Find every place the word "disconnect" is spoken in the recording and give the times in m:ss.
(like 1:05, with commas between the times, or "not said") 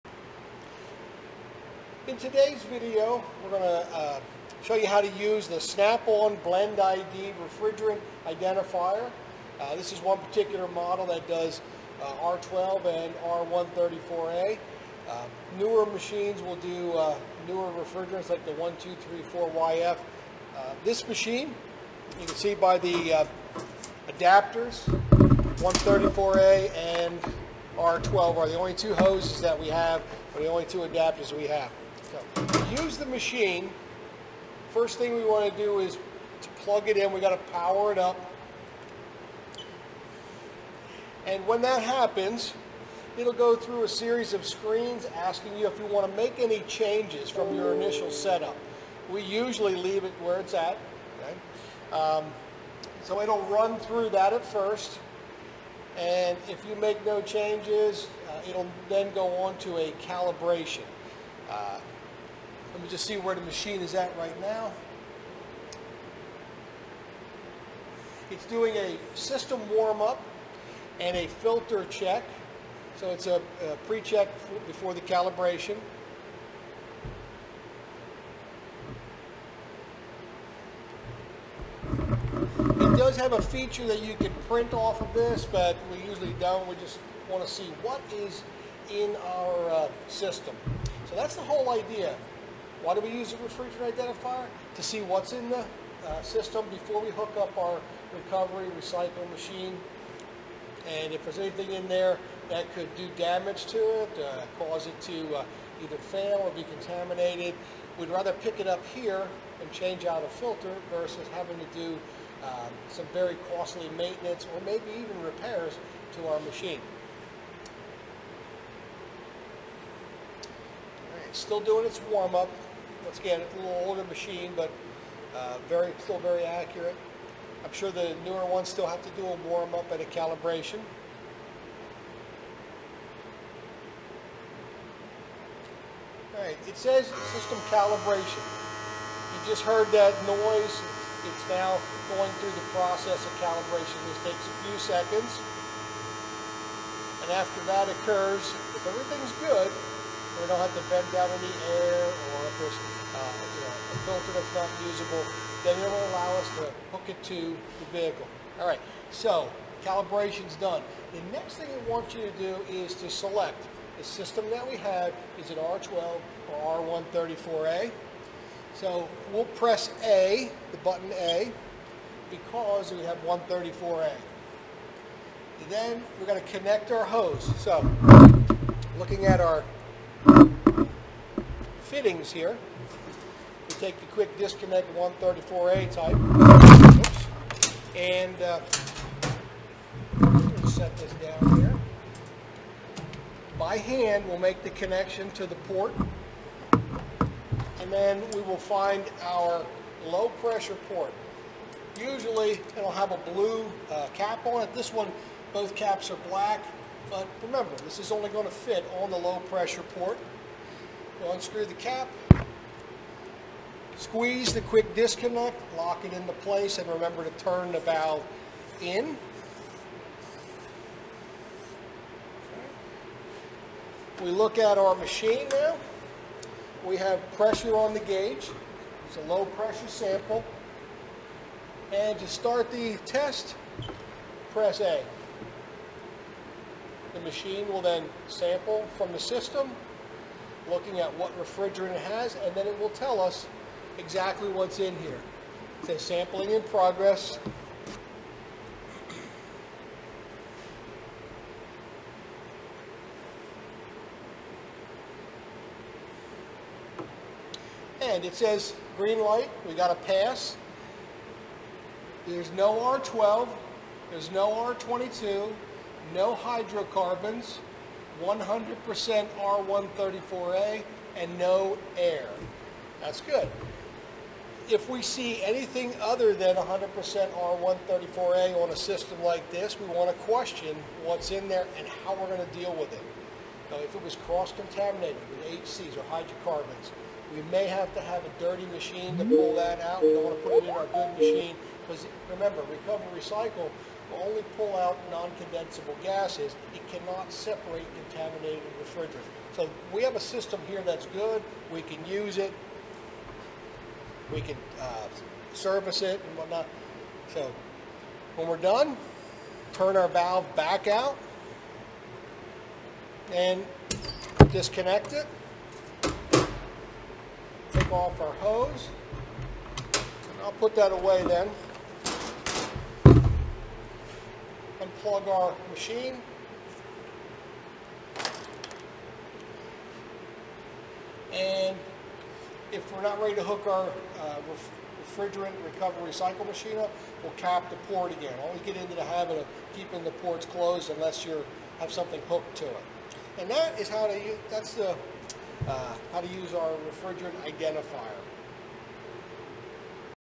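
3:04, 3:34, 5:14.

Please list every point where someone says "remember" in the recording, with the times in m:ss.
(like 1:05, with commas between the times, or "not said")
3:27, 3:36, 4:52.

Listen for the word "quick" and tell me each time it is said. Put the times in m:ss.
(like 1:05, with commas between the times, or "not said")
3:04, 3:34.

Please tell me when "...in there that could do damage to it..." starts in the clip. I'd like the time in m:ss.
1:41.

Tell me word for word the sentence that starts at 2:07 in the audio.
I'm sure the newer ones still have to do a warm-up and a calibration.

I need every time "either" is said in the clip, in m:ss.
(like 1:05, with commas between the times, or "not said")
1:45.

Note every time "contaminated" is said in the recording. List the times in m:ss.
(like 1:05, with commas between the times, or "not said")
1:46, 4:44, 4:58.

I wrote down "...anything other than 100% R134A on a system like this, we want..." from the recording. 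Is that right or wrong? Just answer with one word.
right.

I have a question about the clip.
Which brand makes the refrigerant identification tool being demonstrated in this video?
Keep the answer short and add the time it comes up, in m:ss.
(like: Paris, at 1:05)
Snap-on, at 0:05.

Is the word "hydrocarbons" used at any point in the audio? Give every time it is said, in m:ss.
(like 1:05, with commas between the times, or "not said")
4:26, 4:46.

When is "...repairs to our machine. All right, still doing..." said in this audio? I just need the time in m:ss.
1:55.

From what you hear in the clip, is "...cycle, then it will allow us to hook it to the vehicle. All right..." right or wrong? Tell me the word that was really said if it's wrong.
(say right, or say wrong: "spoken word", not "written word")
wrong: "usable", not "cycle".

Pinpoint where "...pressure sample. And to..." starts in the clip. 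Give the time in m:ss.
3:49.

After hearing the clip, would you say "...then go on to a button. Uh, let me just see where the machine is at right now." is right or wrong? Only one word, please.
wrong.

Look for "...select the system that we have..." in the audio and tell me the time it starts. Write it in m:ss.
2:43.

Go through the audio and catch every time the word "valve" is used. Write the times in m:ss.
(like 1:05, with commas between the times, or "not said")
3:37, 5:10.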